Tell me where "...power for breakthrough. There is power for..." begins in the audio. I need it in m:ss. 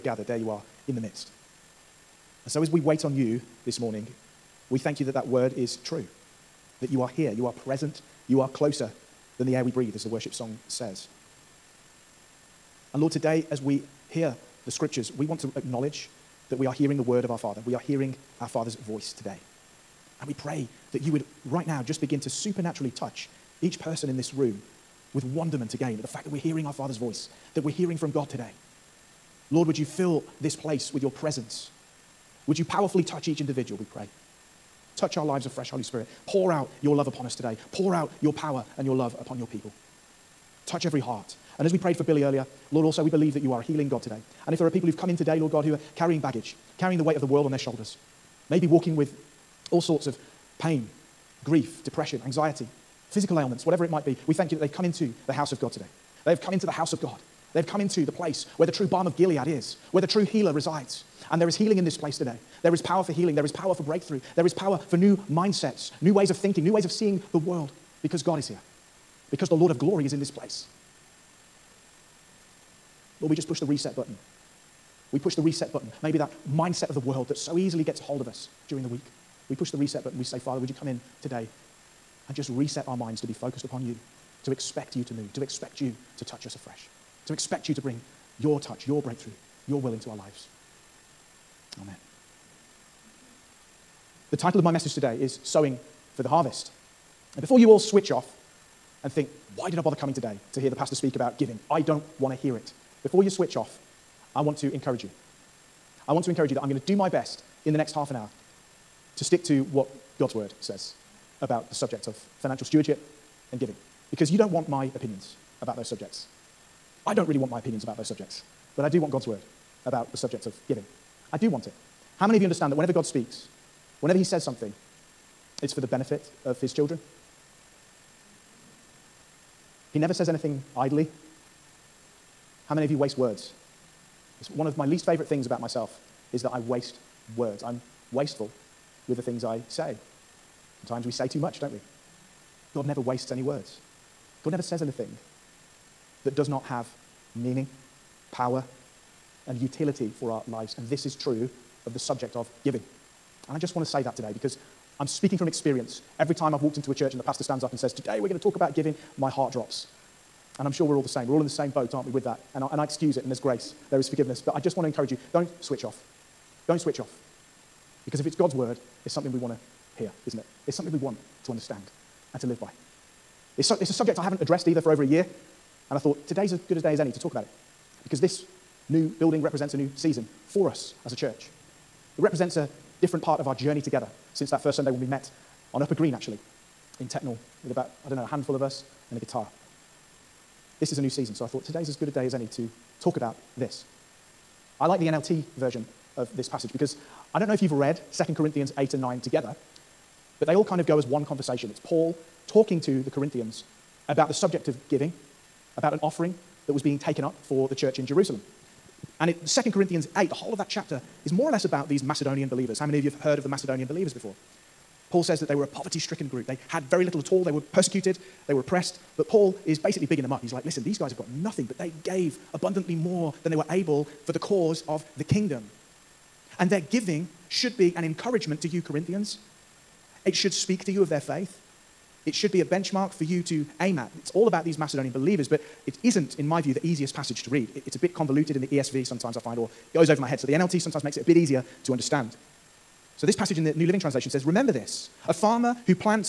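1:03.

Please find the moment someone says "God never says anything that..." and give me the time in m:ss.
2:24.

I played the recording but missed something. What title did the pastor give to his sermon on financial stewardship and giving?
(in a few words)
Sowing for the Harvest.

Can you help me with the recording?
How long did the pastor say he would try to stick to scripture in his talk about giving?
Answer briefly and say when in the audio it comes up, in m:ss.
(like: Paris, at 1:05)
half an hour, at 1:47.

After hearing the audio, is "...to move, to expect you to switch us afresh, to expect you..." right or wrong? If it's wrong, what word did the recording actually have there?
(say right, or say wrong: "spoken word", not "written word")
wrong: "touch", not "switch".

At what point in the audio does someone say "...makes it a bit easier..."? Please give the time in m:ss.
4:01.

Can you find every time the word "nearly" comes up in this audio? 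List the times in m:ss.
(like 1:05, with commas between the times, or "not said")
not said.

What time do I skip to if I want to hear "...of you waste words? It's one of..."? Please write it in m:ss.
2:12.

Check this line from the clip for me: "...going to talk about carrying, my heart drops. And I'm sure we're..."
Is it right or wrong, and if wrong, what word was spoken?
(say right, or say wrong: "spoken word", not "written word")
wrong: "giving", not "carrying".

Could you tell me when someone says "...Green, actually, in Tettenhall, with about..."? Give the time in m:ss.
3:05.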